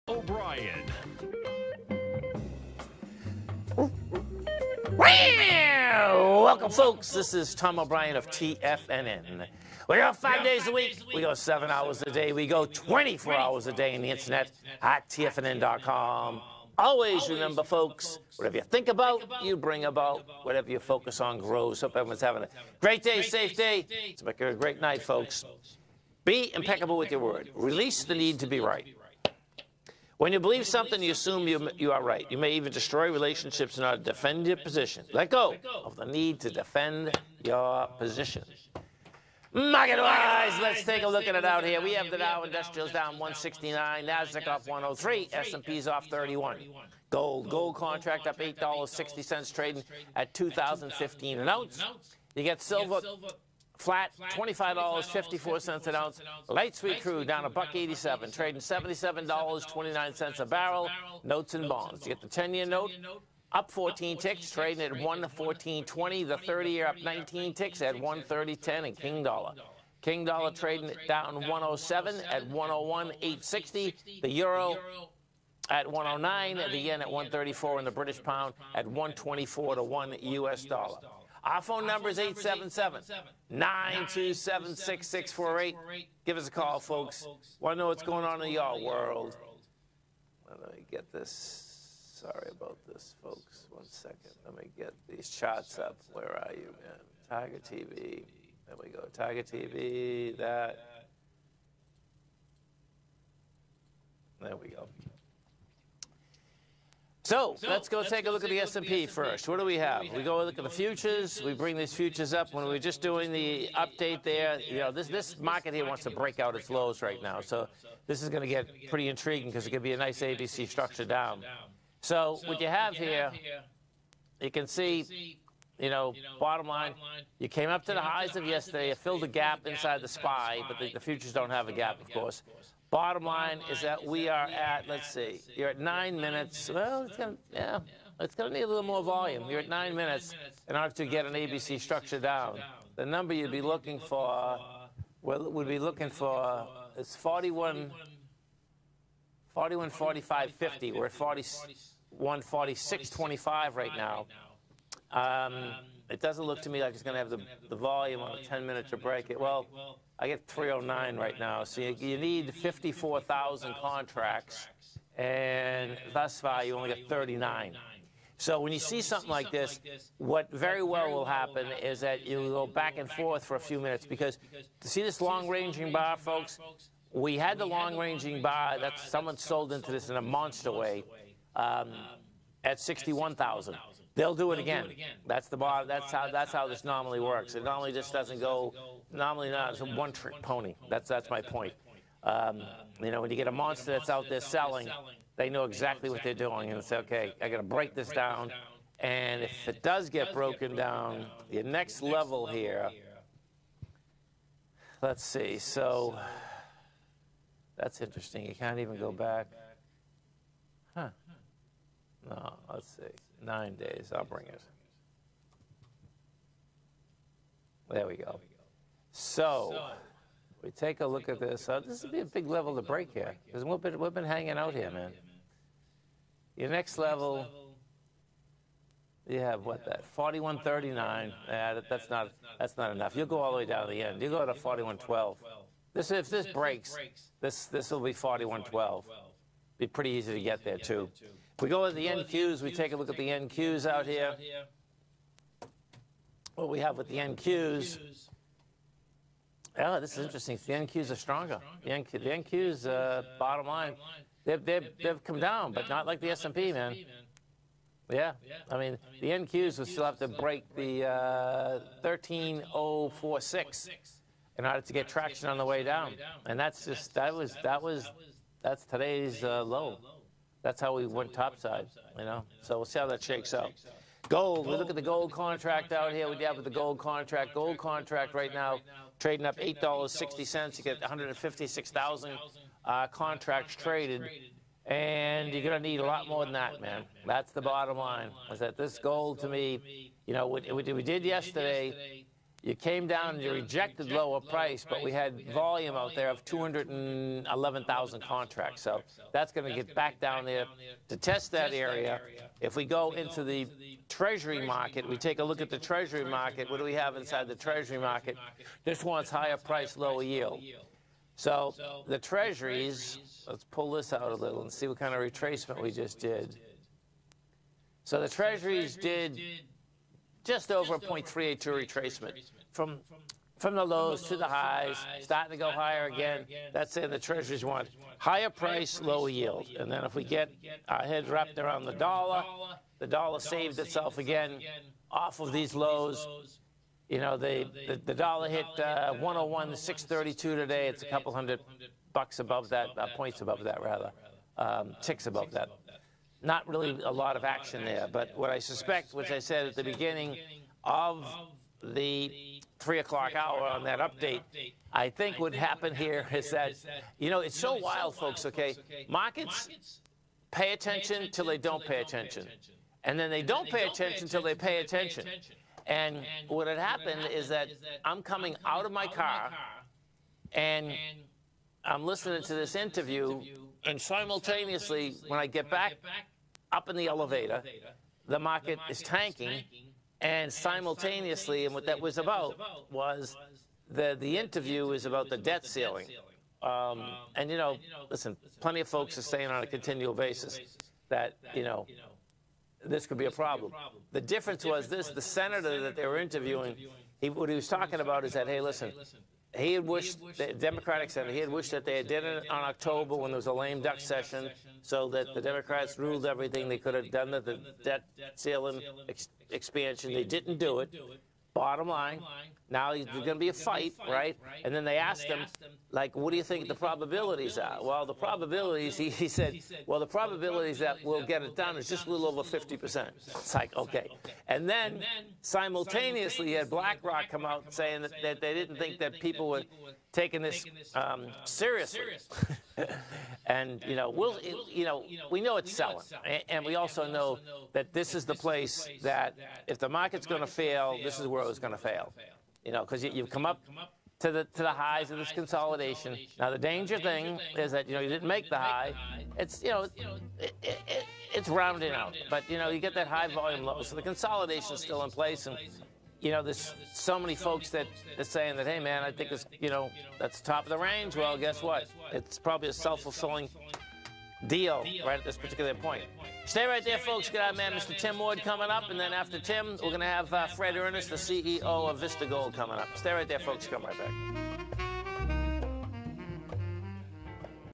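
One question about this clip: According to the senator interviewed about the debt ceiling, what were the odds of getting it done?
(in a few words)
a little over 50%.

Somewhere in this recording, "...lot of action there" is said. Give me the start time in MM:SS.
05:47.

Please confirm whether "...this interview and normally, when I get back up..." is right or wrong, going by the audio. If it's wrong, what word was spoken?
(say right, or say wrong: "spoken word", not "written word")
wrong: "simultaneously", not "normally".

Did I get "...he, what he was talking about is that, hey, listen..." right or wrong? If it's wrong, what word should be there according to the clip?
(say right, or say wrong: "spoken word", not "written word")
right.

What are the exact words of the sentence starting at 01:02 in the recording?
You get the 10-year note up 14 ticks, trading at 114.20.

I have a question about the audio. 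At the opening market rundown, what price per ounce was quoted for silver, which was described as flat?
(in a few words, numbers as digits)
$25.54.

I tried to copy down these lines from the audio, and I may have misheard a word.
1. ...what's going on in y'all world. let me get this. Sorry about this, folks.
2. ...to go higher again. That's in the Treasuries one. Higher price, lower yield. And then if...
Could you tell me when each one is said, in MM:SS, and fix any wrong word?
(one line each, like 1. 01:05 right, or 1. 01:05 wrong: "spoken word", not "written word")
1. 01:27 right
2. 05:25 right.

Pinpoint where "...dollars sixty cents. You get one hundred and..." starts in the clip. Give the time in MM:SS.
04:39.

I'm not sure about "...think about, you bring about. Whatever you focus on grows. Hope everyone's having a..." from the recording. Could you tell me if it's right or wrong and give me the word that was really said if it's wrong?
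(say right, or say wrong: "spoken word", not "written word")
right.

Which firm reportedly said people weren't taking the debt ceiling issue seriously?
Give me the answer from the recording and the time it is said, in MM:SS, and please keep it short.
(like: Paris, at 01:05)
BlackRock, at 07:06.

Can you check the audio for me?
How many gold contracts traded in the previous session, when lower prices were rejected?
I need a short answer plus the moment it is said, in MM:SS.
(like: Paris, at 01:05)
211,000, at 04:56.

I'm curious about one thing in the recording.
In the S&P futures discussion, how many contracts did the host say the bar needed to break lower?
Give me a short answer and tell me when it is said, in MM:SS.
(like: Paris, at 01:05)
54,000, at 02:42.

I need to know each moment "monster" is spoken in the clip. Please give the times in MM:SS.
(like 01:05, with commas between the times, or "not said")
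03:00, 03:13.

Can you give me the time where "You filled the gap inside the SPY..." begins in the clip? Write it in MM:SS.
02:08.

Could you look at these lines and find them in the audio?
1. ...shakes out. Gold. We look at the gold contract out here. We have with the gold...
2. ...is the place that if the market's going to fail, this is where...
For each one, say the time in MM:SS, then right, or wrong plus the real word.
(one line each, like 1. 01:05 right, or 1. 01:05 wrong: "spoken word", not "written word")
1. 04:33 right
2. 07:18 right.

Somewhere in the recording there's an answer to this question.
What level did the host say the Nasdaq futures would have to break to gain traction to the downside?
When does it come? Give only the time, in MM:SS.
04:22.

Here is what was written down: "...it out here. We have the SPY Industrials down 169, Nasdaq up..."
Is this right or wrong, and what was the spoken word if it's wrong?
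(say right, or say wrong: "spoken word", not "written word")
wrong: "Dow", not "SPY".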